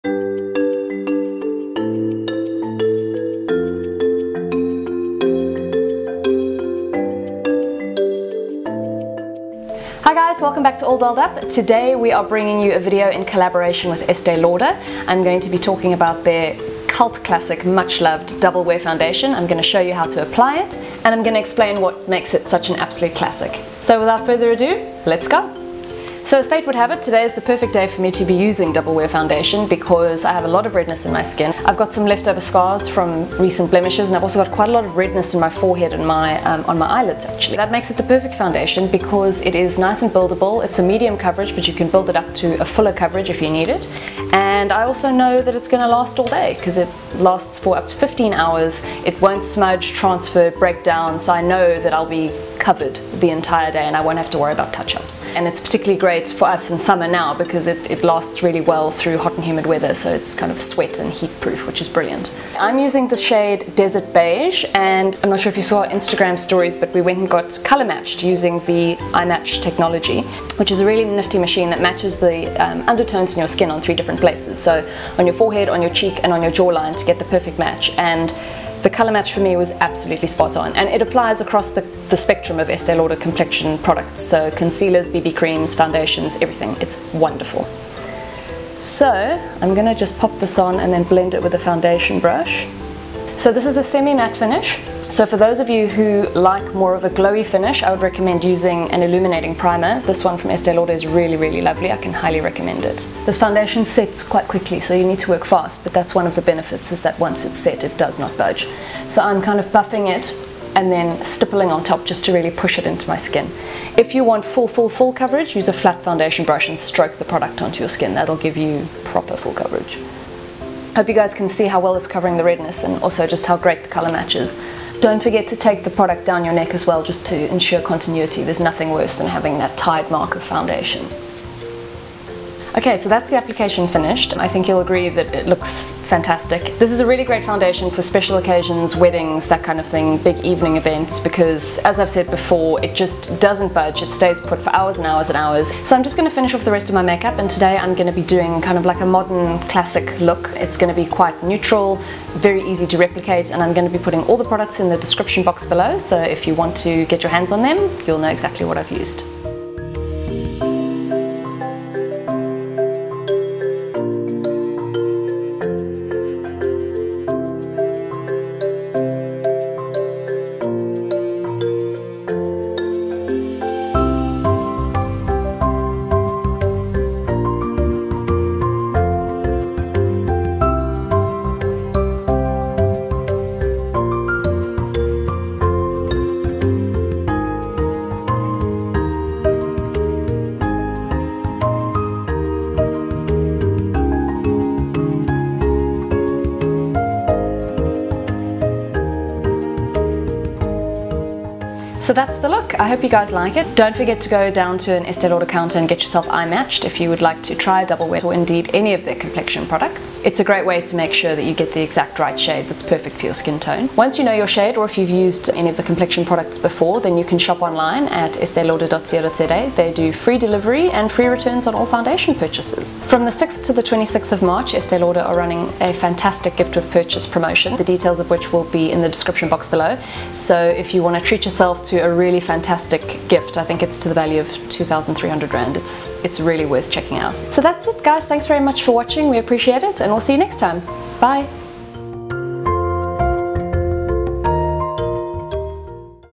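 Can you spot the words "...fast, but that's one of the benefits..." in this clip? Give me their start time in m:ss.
1:45.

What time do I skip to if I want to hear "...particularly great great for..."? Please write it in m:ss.
0:55.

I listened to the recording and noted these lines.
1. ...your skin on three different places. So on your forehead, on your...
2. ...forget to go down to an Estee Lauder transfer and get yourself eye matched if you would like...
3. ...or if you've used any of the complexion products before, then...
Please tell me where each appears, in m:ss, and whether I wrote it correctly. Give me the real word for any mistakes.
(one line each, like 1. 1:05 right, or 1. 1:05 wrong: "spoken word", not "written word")
1. 1:13 right
2. 3:23 wrong: "counter", not "transfer"
3. 3:34 right.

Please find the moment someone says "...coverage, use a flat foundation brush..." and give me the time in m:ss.
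1:55.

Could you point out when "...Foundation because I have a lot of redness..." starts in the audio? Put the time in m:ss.
0:29.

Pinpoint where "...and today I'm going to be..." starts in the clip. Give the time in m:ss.
2:27.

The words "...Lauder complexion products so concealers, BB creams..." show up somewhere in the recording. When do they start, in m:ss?
1:22.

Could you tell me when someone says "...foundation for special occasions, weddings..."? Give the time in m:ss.
2:17.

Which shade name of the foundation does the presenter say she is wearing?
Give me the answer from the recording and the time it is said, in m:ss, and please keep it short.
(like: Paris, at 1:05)
Desert Beige, at 1:03.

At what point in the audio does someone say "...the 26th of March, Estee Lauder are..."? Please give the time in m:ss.
3:43.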